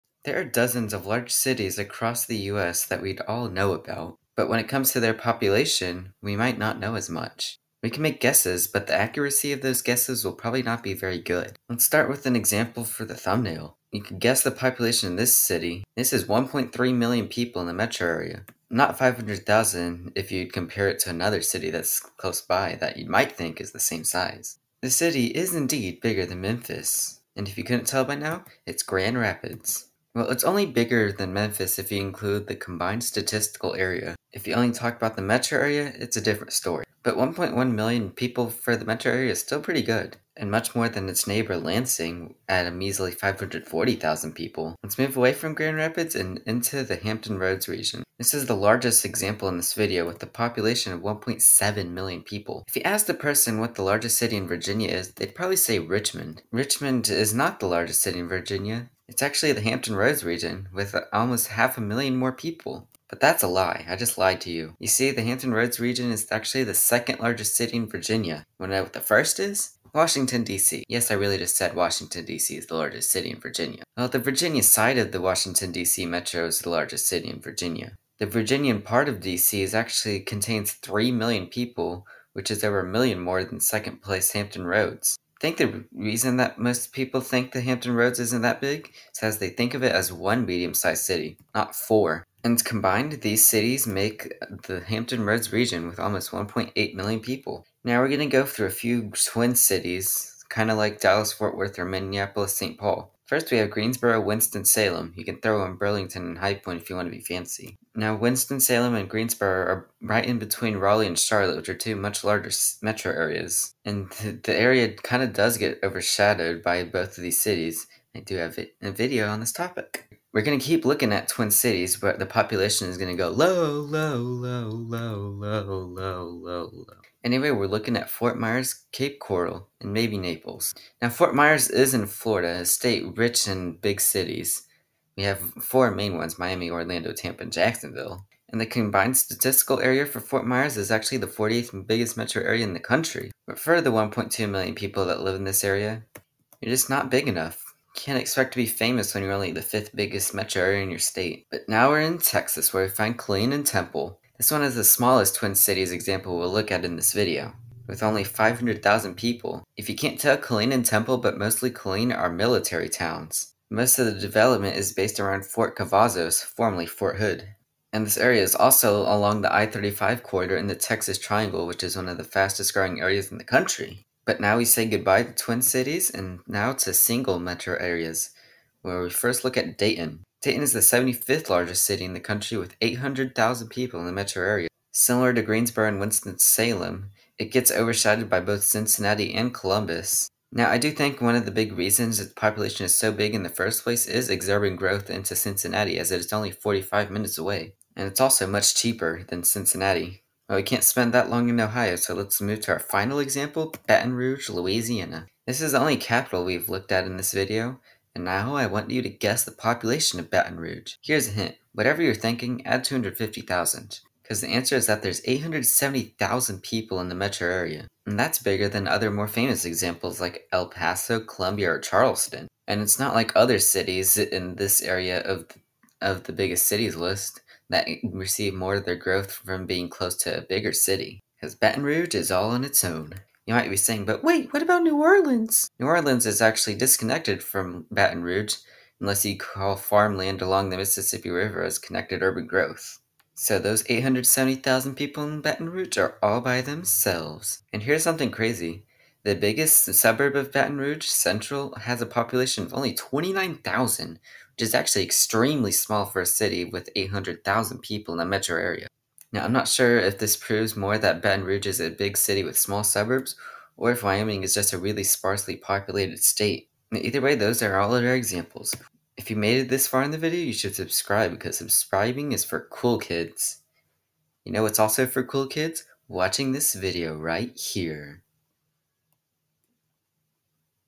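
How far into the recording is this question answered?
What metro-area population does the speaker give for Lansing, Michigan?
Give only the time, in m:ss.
0:43.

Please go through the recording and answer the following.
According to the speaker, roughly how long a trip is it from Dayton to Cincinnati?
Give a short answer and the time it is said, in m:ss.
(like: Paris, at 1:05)
45 minutes, at 3:16.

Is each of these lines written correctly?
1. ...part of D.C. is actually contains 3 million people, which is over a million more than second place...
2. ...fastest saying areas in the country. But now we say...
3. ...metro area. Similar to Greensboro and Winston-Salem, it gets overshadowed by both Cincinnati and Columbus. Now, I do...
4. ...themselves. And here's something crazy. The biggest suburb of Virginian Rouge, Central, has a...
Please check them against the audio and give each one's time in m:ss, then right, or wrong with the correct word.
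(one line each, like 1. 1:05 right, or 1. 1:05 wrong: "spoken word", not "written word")
1. 1:18 right
2. 2:52 wrong: "growing", not "saying"
3. 3:04 right
4. 4:06 wrong: "Baton", not "Virginian".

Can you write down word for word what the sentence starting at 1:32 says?
And combined, these cities make the Hampton Roads region with almost 1.8 million people.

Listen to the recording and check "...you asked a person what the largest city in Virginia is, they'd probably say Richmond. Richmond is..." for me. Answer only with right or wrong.
right.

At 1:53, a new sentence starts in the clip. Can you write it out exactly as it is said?
And the area kind of does get overshadowed by both of these cities.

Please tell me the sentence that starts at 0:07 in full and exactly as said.
We can make guesses, but the accuracy of those guesses will probably not be very good.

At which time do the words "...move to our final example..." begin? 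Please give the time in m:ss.
3:22.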